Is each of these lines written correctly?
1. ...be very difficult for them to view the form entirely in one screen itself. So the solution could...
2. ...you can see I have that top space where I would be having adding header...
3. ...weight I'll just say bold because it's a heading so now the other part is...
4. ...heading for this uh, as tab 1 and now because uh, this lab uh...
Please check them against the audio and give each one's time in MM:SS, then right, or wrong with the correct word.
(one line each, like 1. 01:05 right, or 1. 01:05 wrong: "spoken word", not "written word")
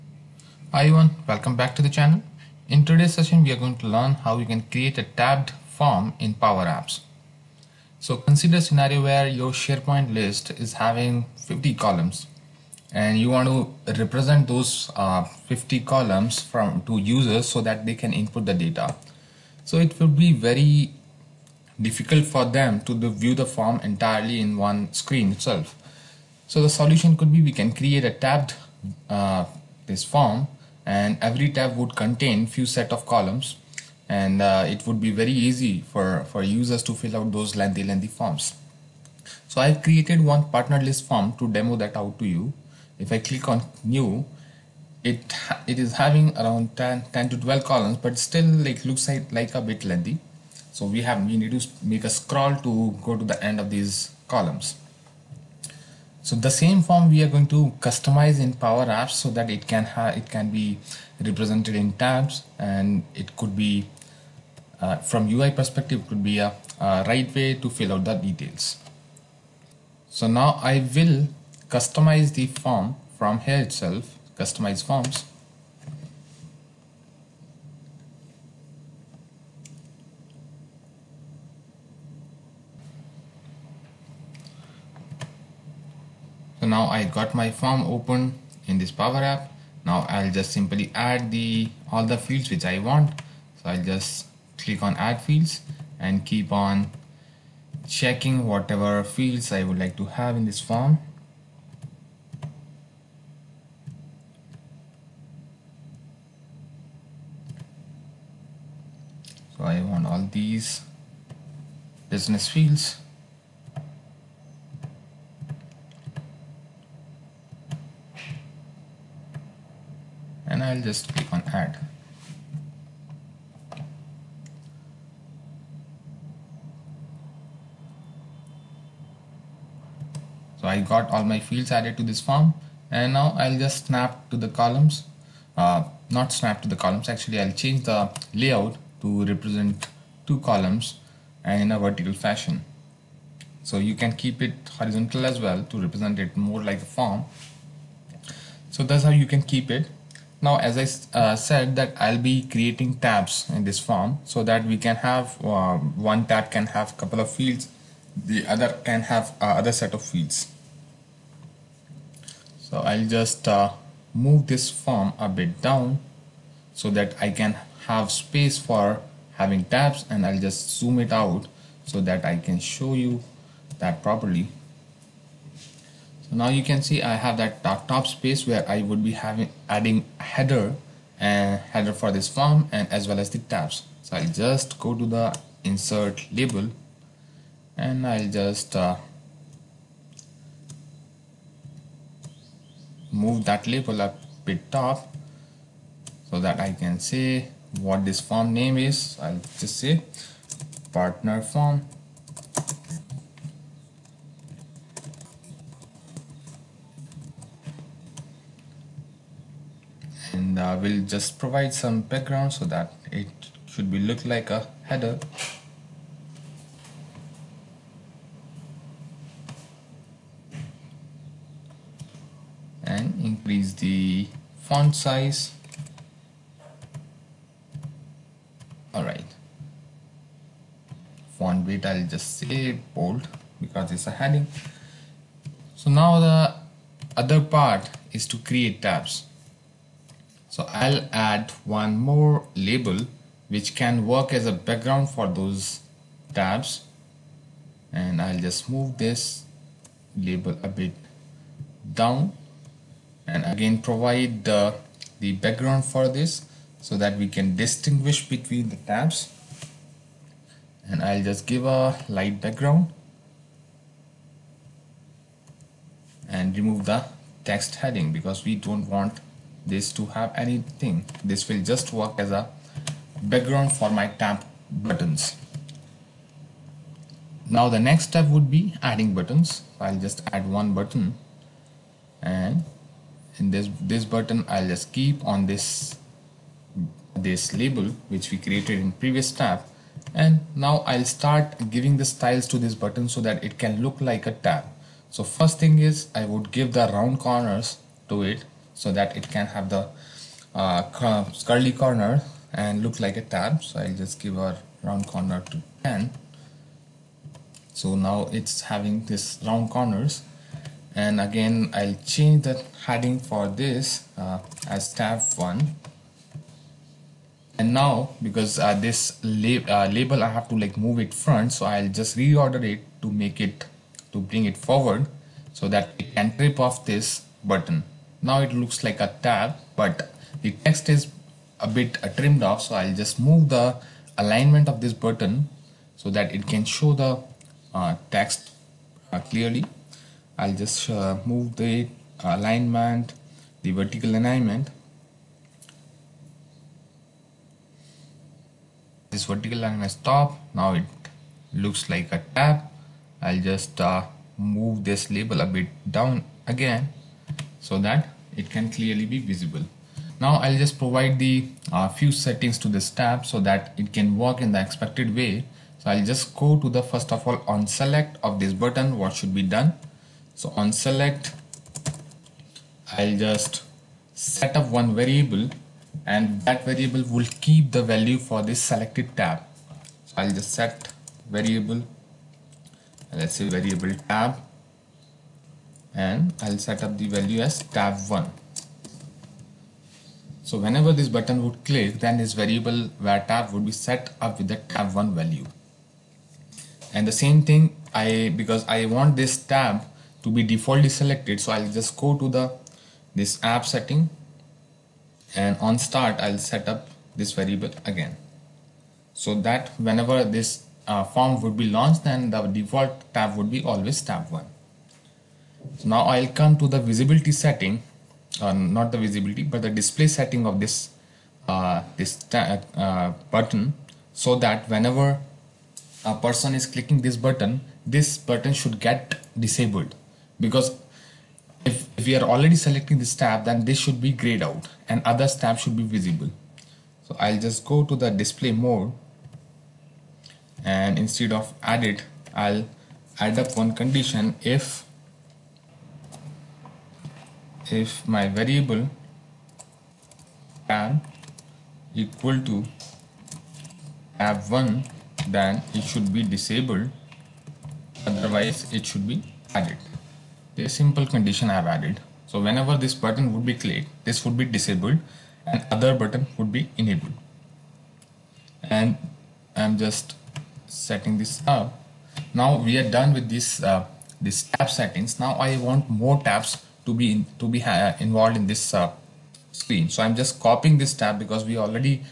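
1. 00:20 right
2. 02:56 right
3. 03:51 right
4. 05:12 right.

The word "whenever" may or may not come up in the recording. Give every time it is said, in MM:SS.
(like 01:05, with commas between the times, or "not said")
06:30, 06:49, 07:04, 07:42.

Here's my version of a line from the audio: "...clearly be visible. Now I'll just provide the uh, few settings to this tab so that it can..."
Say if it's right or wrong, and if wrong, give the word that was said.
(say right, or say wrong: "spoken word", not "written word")
right.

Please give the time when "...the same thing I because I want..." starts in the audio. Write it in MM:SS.
06:37.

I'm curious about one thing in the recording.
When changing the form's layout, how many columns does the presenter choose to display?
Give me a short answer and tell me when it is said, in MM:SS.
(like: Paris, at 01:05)
two, at 02:20.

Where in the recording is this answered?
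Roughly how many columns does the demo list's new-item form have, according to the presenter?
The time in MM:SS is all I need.
00:47.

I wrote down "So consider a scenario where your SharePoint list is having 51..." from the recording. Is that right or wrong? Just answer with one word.
wrong.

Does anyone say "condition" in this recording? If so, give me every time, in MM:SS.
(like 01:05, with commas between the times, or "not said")
07:23, 07:41.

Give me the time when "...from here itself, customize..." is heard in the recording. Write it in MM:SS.
01:13.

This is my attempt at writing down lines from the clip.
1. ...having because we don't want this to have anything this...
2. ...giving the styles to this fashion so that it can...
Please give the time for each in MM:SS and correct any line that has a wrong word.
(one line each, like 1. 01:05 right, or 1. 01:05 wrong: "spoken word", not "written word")
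1. 04:27 wrong: "heading", not "having"
2. 04:51 wrong: "button", not "fashion".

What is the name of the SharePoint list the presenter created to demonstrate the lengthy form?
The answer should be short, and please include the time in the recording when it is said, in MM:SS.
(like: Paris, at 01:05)
partner list, at 00:40.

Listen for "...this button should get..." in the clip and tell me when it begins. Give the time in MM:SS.
07:07.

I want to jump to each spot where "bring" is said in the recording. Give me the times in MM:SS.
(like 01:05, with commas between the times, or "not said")
05:24.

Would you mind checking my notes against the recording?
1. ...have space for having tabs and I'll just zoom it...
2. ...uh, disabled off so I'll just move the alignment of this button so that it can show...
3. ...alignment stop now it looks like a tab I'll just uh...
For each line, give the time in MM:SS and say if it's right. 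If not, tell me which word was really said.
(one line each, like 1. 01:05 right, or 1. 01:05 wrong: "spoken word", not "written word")
1. 02:47 right
2. 05:32 wrong: "trimmed", not "disabled"
3. 05:49 right.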